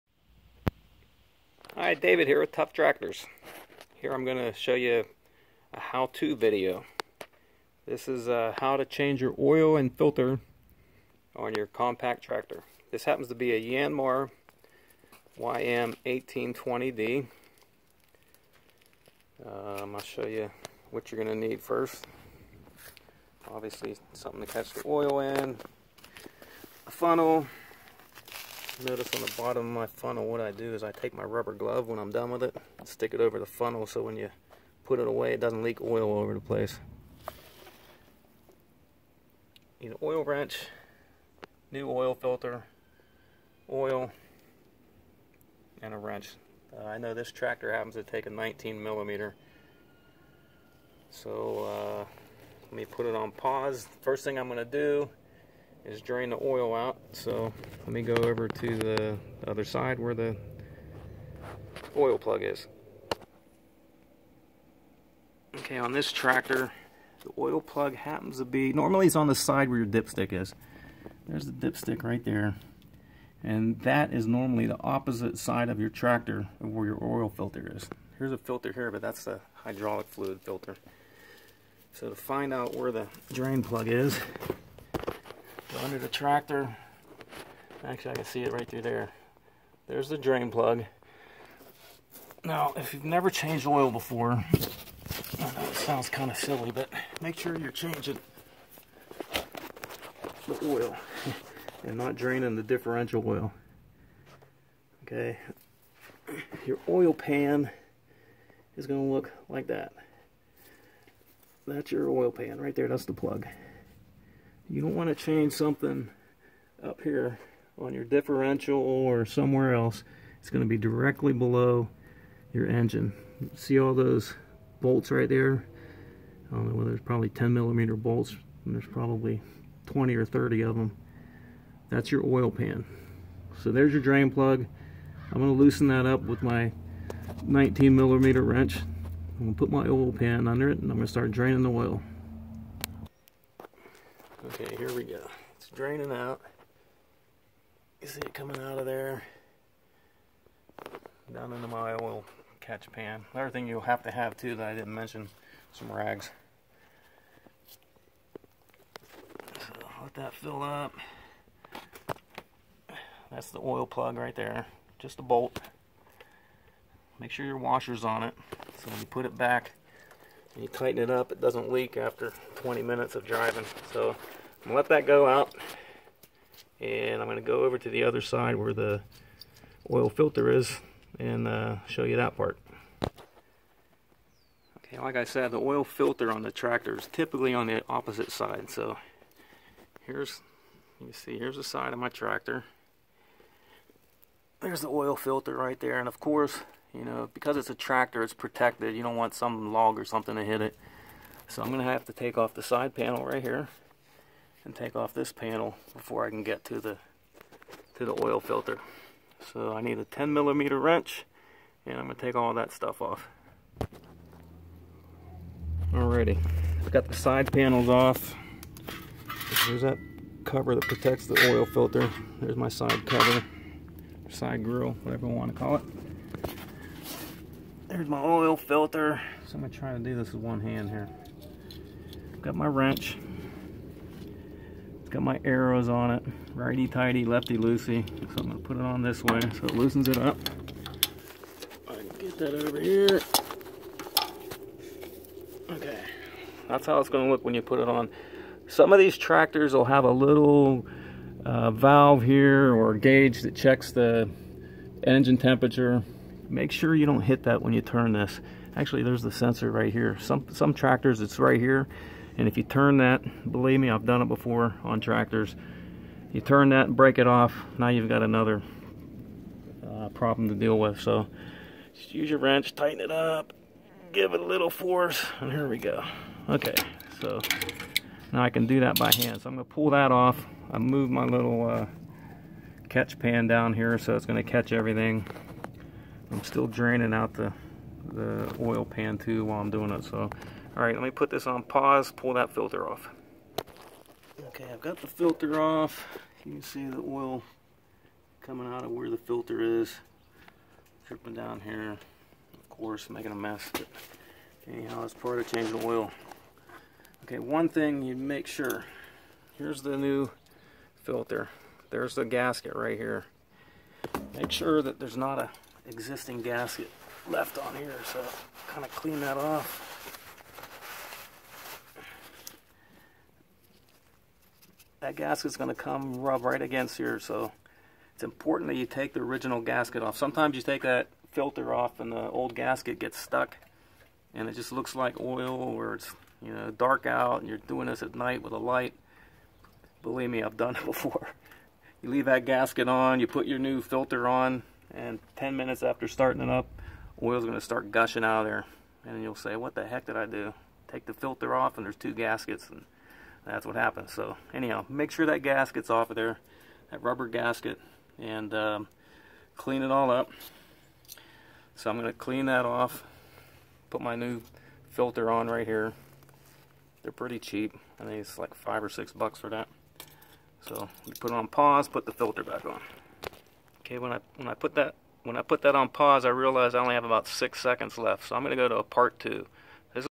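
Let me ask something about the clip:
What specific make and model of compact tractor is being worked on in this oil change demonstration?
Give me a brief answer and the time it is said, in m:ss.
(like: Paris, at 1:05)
Yanmar YM1820D, at 0:13.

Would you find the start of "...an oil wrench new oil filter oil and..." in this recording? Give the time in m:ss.
0:39.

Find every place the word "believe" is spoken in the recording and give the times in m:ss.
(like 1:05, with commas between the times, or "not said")
4:23, 5:40.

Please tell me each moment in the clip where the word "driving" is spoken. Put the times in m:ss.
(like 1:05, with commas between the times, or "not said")
2:53.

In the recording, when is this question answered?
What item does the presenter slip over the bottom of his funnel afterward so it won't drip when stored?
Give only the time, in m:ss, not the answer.
0:31.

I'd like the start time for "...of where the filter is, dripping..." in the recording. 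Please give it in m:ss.
4:58.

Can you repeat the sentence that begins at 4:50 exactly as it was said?
So, all right, let me put this on pause, pull that filter off.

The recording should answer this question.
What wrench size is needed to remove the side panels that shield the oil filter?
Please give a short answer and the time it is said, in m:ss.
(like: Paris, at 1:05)
10 millimeter, at 3:30.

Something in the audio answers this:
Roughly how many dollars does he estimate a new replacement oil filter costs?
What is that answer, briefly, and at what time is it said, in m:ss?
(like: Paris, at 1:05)
5 or 6 dollars, at 6:08.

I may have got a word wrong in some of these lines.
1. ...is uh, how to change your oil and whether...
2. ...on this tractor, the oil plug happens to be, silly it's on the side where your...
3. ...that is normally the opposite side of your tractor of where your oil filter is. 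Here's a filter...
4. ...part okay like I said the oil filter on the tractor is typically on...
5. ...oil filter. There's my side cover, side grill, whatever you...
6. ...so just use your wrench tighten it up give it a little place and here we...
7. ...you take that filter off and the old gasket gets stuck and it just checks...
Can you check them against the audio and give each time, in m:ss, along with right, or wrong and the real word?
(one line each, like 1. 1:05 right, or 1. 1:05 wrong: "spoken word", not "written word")
1. 0:08 wrong: "filter", not "whether"
2. 1:05 wrong: "normally", not "silly"
3. 1:13 right
4. 3:02 right
5. 3:41 right
6. 4:30 wrong: "force", not "place"
7. 5:30 wrong: "looks", not "checks".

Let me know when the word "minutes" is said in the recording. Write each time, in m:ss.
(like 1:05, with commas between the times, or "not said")
2:52, 5:45.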